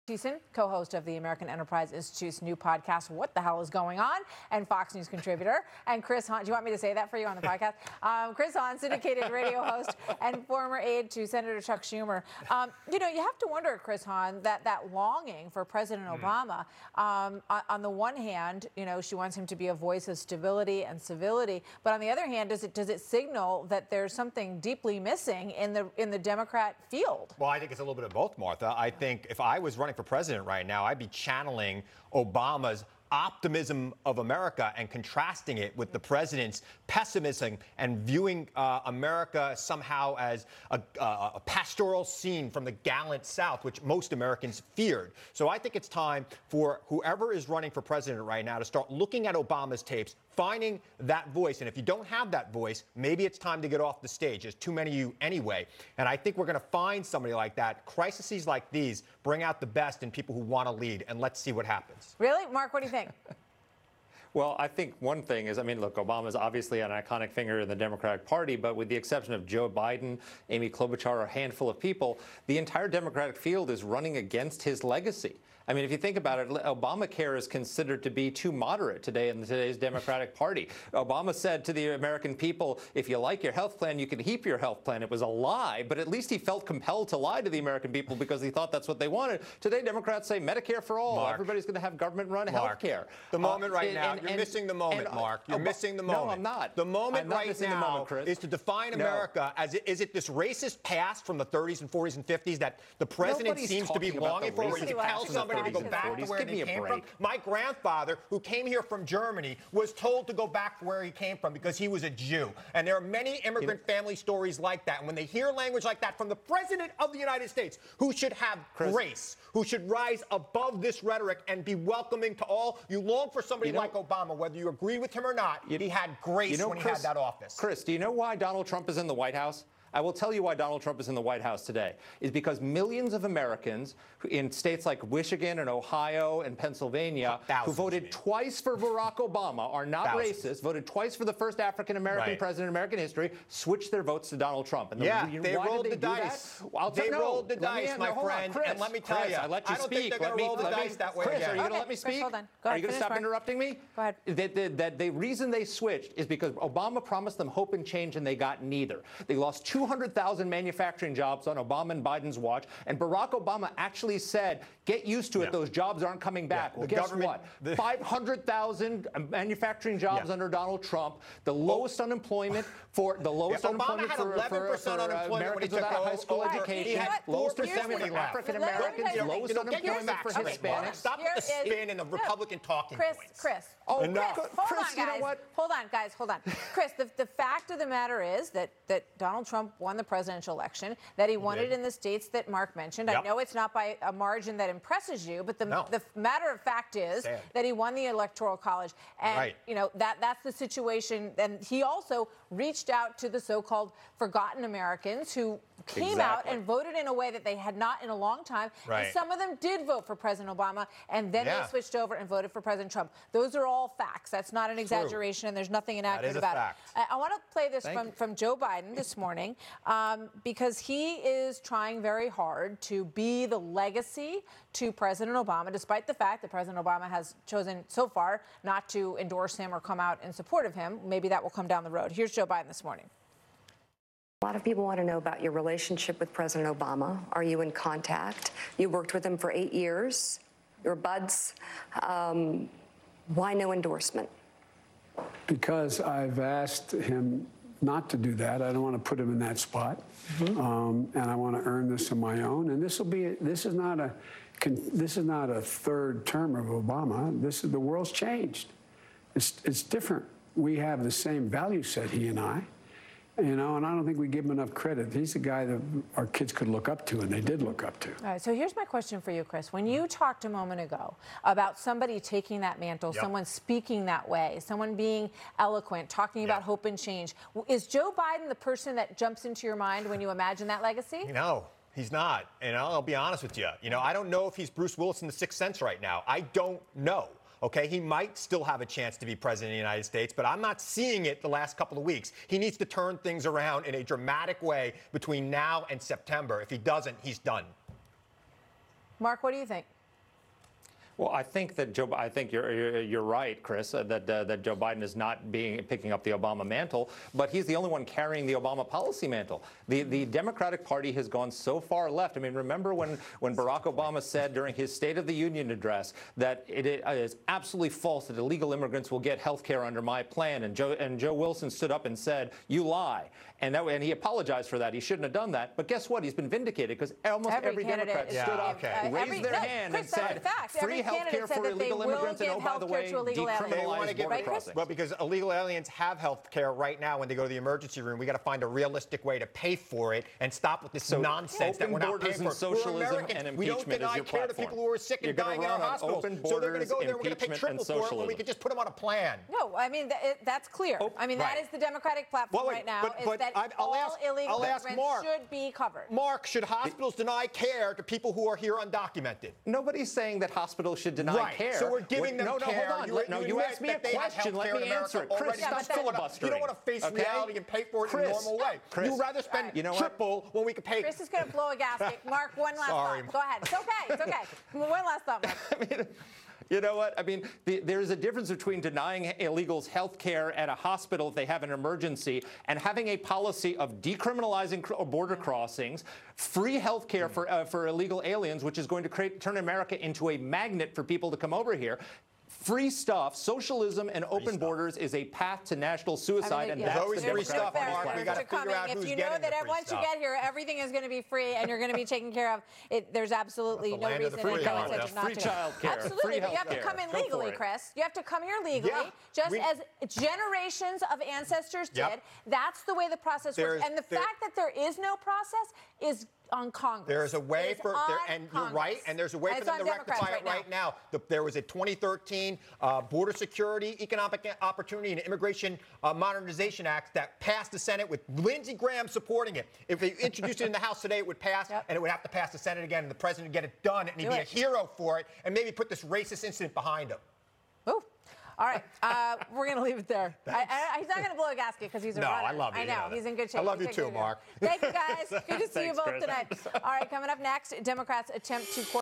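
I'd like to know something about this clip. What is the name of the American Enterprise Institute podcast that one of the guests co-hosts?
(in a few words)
What the Hell is Going On?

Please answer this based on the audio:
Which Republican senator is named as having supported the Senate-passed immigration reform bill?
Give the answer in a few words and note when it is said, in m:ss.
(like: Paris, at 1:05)
Lindsey Graham, at 7:08.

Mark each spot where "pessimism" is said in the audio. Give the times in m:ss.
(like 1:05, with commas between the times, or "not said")
0:36.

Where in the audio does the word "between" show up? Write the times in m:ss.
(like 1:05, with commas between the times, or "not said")
4:55, 6:18.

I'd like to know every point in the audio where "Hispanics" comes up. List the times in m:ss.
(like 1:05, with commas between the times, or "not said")
3:00.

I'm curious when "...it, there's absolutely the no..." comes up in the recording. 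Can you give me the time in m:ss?
6:42.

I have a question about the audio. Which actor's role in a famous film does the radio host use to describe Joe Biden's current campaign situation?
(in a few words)
Bruce Willis.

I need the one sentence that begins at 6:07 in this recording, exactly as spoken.
reality and pay for it Chris, in a normal way.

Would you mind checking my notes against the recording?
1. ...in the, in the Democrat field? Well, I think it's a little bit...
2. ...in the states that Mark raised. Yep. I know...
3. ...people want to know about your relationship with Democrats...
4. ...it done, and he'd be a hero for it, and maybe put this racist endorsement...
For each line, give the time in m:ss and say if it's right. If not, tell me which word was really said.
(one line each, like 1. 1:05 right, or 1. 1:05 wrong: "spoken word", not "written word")
1. 0:25 right
2. 3:11 wrong: "mentioned", not "raised"
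3. 3:54 wrong: "President", not "Democrats"
4. 7:13 wrong: "incident", not "endorsement".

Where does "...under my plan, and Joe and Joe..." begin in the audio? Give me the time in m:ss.
5:19.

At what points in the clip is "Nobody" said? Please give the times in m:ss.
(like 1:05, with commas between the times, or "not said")
1:43, 5:59.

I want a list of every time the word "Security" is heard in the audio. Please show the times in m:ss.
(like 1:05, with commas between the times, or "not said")
7:03.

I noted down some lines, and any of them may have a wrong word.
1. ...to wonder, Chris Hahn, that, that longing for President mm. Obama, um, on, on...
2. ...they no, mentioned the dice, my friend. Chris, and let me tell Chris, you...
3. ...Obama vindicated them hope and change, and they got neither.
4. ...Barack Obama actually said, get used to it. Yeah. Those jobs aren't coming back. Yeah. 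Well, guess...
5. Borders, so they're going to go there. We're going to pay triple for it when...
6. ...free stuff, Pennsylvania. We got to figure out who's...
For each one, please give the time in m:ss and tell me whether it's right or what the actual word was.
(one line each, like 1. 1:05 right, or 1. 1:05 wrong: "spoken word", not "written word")
1. 0:13 right
2. 2:26 wrong: "rolled", not "mentioned"
3. 2:36 wrong: "promised", not "vindicated"
4. 2:42 right
5. 5:46 right
6. 6:37 wrong: "Mark", not "Pennsylvania".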